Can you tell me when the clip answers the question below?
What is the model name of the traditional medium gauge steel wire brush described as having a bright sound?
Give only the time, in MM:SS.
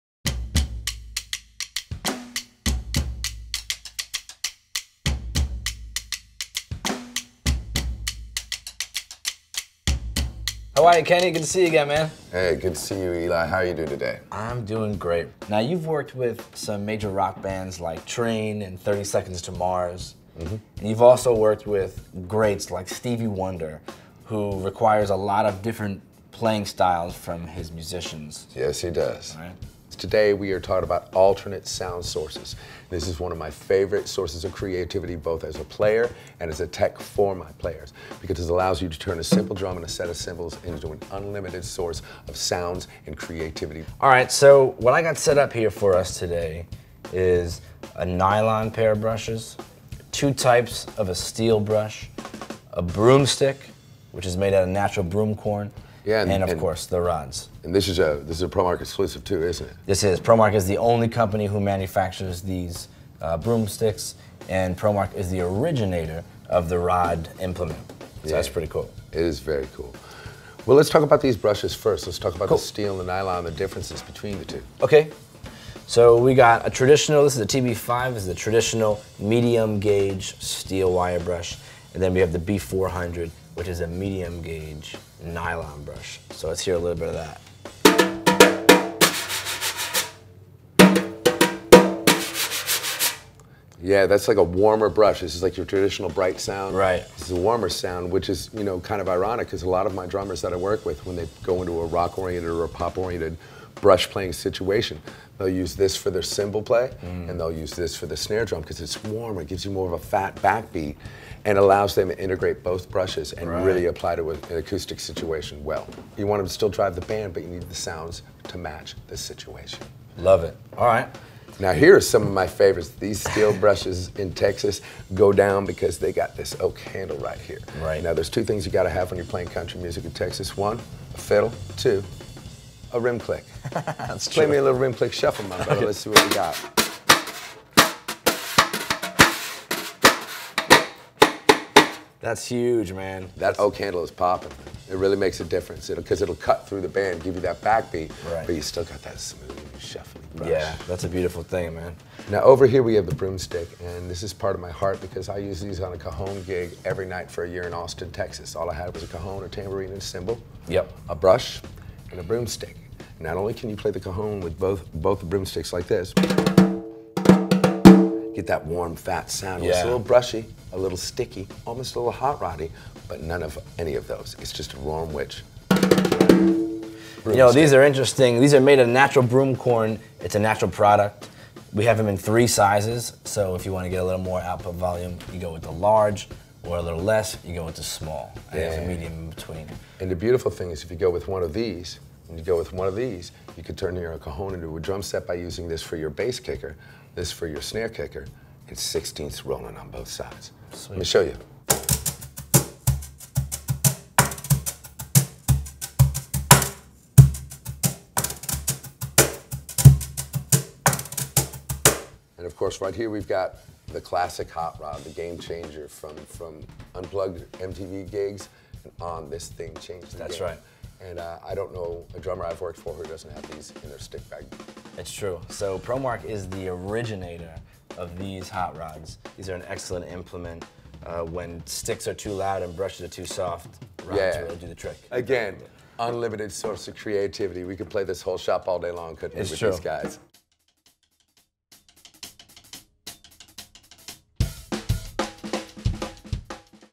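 01:17.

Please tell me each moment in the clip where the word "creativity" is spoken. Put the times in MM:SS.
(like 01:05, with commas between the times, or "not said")
00:34, 00:43, 03:56.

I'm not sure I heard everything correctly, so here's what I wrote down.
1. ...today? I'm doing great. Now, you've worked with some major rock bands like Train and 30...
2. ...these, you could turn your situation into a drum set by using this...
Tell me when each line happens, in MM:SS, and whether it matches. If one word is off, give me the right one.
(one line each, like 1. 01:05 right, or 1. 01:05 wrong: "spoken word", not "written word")
1. 00:13 right
2. 03:12 wrong: "cajon", not "situation".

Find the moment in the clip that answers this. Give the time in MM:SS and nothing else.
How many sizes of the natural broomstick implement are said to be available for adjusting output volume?
03:02.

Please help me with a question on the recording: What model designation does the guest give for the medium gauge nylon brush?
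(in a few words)
B400.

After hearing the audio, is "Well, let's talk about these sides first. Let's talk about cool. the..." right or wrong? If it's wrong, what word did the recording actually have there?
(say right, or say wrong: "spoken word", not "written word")
wrong: "brushes", not "sides".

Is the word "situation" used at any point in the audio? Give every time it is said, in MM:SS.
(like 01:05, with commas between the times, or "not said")
01:44, 01:54, 01:59.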